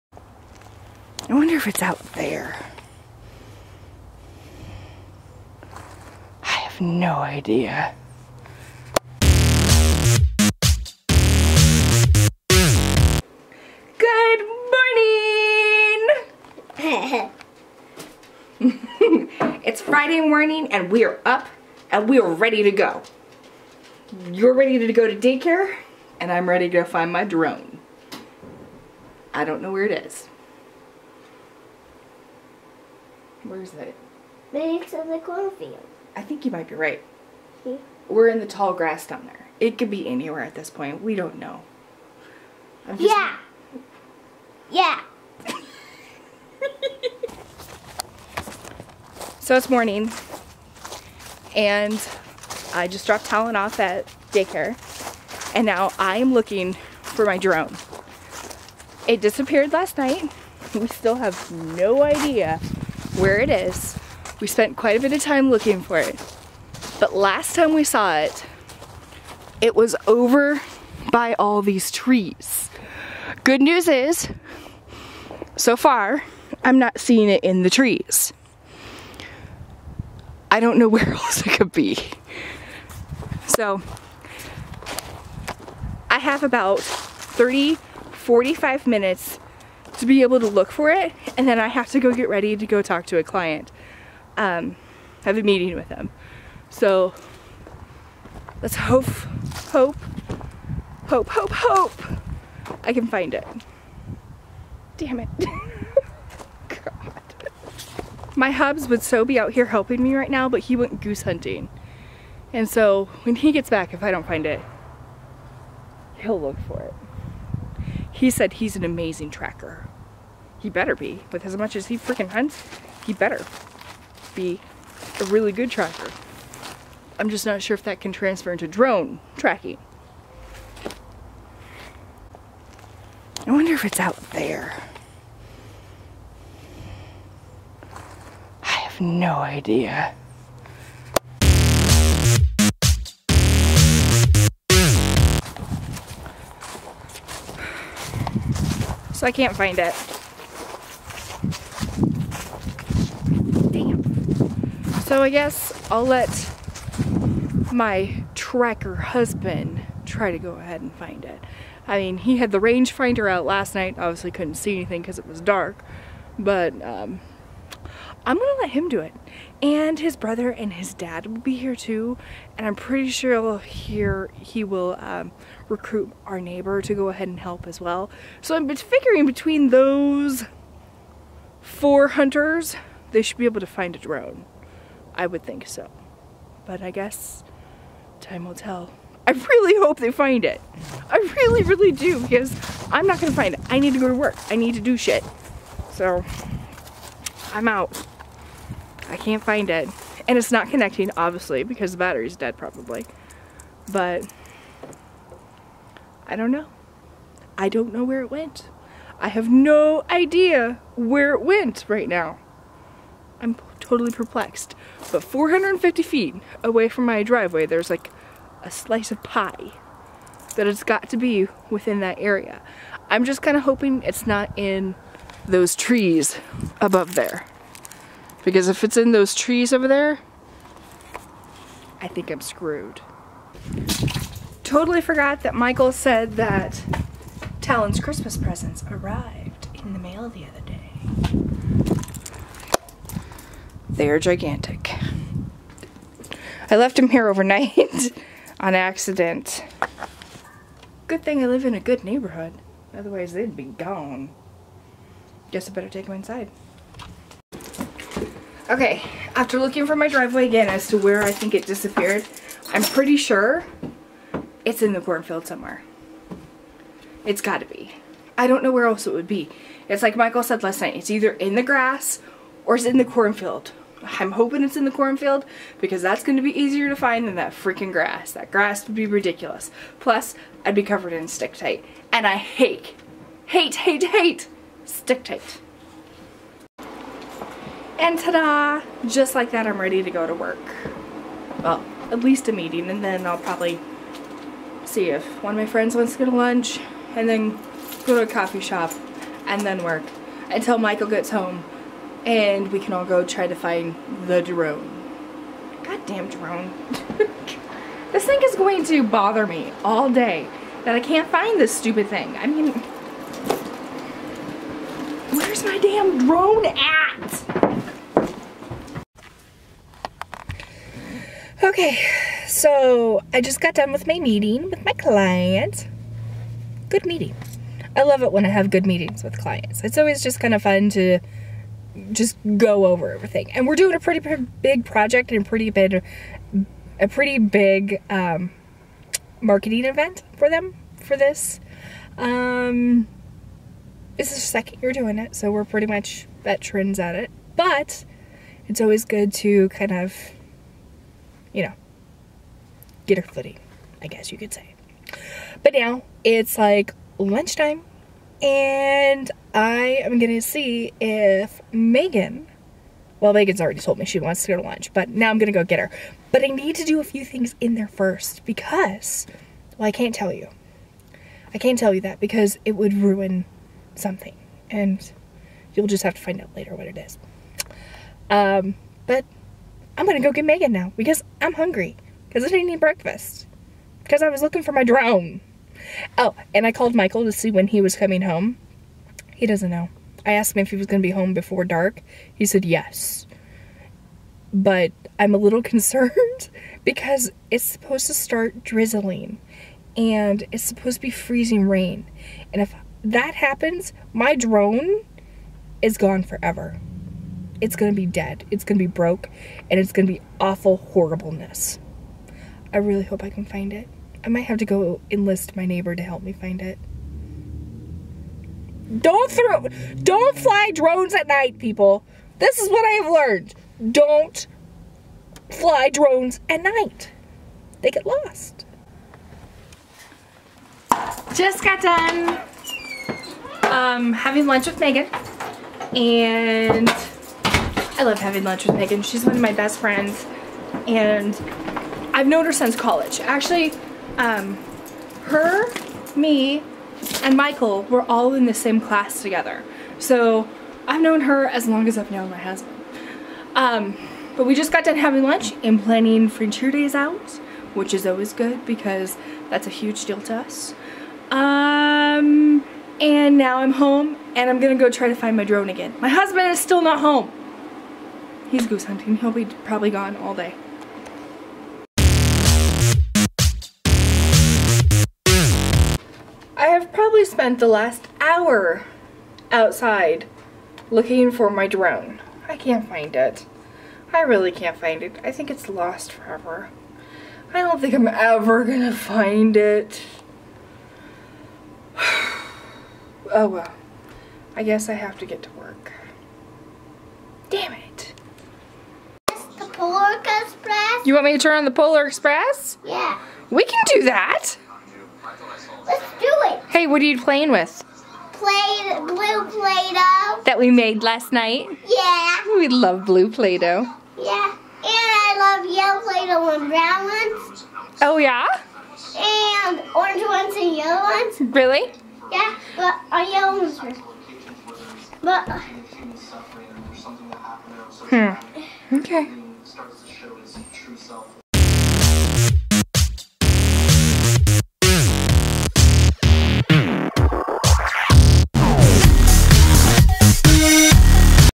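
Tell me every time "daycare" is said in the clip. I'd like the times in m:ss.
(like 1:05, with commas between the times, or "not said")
0:25, 0:54.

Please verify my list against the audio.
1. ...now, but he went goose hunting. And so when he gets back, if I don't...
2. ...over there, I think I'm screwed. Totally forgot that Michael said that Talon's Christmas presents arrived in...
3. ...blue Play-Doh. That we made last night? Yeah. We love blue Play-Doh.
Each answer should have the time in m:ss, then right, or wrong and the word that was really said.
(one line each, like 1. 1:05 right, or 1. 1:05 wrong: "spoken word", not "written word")
1. 1:50 right
2. 3:49 right
3. 8:28 right.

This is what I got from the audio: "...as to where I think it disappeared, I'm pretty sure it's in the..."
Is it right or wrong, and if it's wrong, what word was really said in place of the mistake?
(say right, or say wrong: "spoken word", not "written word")
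right.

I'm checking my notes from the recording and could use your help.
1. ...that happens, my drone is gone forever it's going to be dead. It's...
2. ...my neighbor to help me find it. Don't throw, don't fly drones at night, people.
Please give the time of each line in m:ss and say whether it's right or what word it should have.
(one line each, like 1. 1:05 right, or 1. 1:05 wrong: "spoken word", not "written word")
1. 6:43 right
2. 6:55 right.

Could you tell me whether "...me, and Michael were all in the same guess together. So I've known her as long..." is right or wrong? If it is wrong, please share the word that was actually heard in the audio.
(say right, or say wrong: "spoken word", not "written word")
wrong: "class", not "guess".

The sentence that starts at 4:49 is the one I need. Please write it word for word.
Just like that, I'm ready to go to work.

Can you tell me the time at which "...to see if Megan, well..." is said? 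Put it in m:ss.
6:00.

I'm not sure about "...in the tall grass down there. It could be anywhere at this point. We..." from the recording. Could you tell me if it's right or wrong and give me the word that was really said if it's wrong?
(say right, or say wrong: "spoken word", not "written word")
right.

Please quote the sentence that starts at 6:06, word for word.
But I need to do a few things in there first because, well, I can't tell you.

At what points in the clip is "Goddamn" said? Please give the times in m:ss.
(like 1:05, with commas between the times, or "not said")
5:05.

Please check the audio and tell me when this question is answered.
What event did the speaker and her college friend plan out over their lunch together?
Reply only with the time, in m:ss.
7:36.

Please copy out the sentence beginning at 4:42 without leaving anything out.
And I hate, hate, hate, hate stick tight.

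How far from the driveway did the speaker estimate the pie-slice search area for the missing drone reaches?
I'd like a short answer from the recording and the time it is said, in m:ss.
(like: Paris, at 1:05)
450 feet, at 3:35.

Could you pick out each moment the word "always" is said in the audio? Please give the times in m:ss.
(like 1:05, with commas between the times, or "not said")
5:29, 5:48, 7:38.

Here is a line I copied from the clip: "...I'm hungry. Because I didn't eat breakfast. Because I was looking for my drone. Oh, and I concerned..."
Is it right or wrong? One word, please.
wrong.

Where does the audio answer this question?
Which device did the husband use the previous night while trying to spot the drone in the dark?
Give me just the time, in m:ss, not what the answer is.
2:42.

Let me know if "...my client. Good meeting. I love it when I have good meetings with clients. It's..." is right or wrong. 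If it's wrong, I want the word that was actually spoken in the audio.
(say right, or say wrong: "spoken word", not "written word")
right.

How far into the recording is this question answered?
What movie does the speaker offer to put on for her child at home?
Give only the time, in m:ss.
8:21.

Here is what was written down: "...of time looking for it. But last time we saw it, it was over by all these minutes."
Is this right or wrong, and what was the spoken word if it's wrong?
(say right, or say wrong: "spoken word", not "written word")
wrong: "trees", not "minutes".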